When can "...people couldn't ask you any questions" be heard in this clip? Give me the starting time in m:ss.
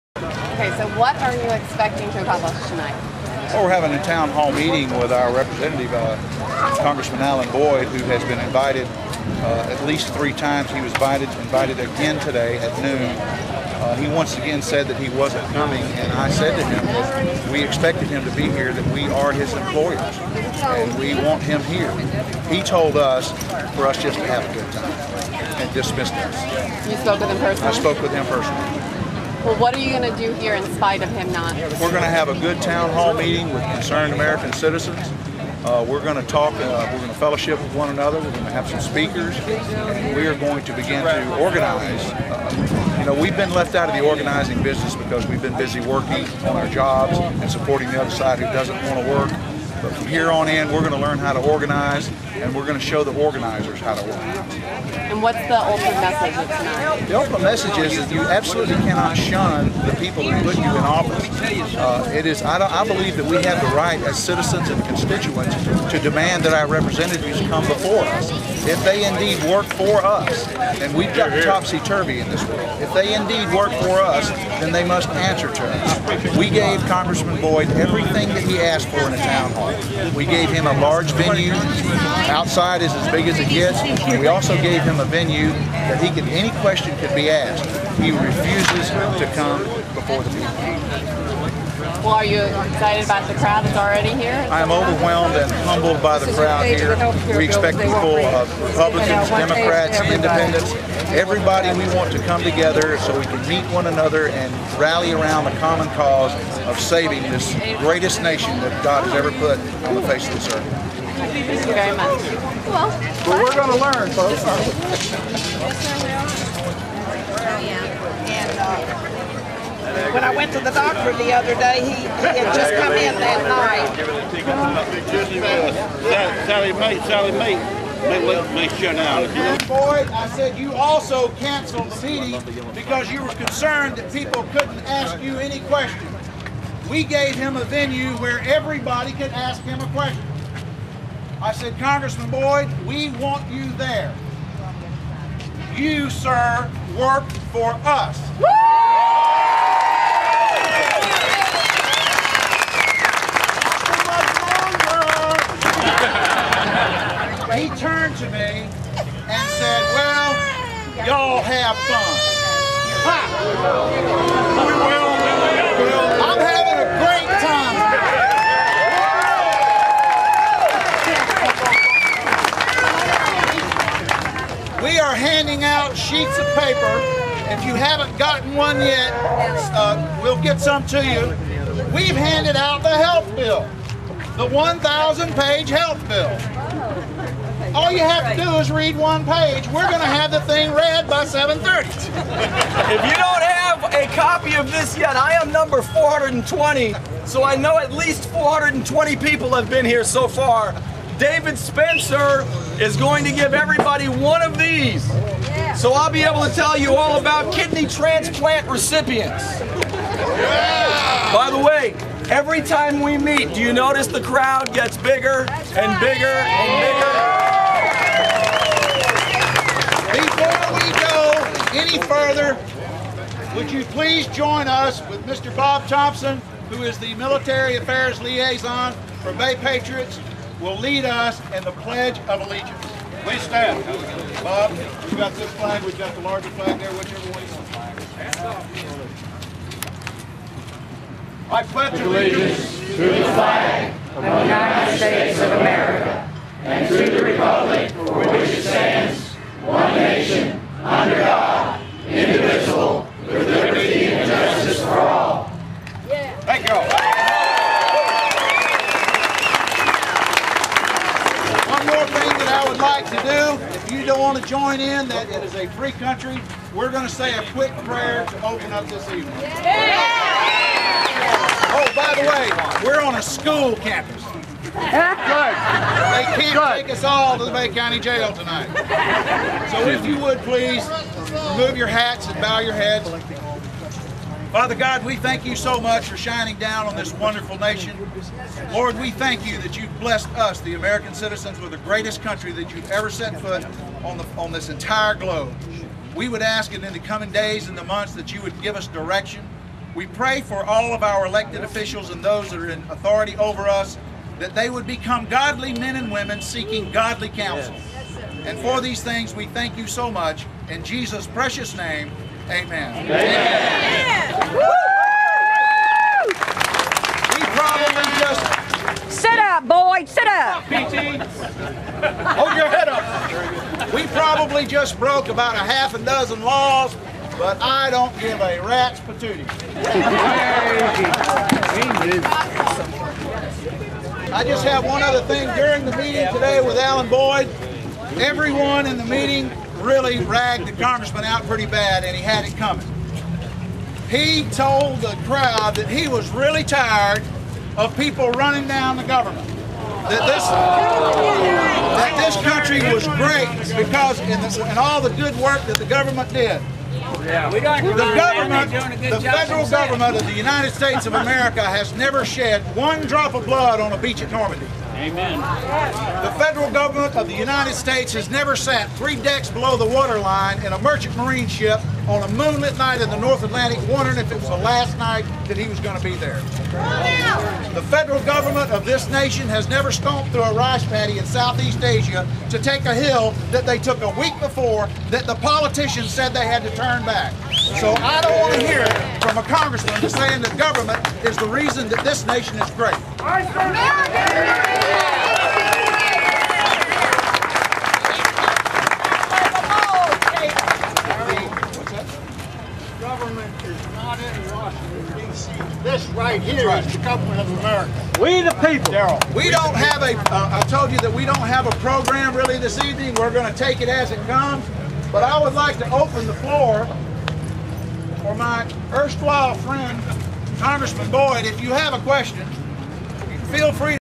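2:14.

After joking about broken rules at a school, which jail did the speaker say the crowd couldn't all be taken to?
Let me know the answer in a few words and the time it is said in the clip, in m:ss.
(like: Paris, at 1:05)
Bay County Jail, at 4:37.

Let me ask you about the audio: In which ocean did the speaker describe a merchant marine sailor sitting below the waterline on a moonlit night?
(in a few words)
North Atlantic.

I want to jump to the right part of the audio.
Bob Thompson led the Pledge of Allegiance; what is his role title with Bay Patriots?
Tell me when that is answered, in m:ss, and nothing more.
3:47.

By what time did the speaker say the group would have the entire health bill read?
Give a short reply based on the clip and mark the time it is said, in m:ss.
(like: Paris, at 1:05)
7:30, at 3:11.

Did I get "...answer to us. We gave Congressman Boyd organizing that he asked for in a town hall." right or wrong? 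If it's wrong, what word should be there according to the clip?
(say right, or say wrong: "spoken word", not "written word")
wrong: "everything", not "organizing".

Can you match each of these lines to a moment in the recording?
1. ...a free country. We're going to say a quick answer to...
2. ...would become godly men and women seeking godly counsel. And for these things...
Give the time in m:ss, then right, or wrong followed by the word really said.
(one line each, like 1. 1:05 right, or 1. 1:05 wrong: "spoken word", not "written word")
1. 4:25 wrong: "prayer", not "answer"
2. 5:04 right.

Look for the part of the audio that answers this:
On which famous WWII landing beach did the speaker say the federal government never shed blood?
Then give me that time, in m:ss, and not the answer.
6:04.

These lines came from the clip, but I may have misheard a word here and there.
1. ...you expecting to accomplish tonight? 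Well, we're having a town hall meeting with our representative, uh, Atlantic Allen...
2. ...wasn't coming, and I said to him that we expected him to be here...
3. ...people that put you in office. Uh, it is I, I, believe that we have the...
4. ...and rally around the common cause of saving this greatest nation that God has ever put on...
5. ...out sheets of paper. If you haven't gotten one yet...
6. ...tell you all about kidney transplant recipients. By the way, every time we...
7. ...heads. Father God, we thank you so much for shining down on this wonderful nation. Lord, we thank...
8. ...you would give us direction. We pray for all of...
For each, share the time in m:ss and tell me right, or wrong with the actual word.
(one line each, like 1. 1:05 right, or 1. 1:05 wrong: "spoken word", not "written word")
1. 0:01 wrong: "Congressman", not "Atlantic"
2. 0:15 right
3. 0:59 right
4. 1:44 right
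5. 2:55 right
6. 3:26 right
7. 4:42 right
8. 4:58 right.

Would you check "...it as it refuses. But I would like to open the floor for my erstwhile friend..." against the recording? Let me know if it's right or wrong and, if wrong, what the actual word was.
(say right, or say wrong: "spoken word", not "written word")
wrong: "comes", not "refuses".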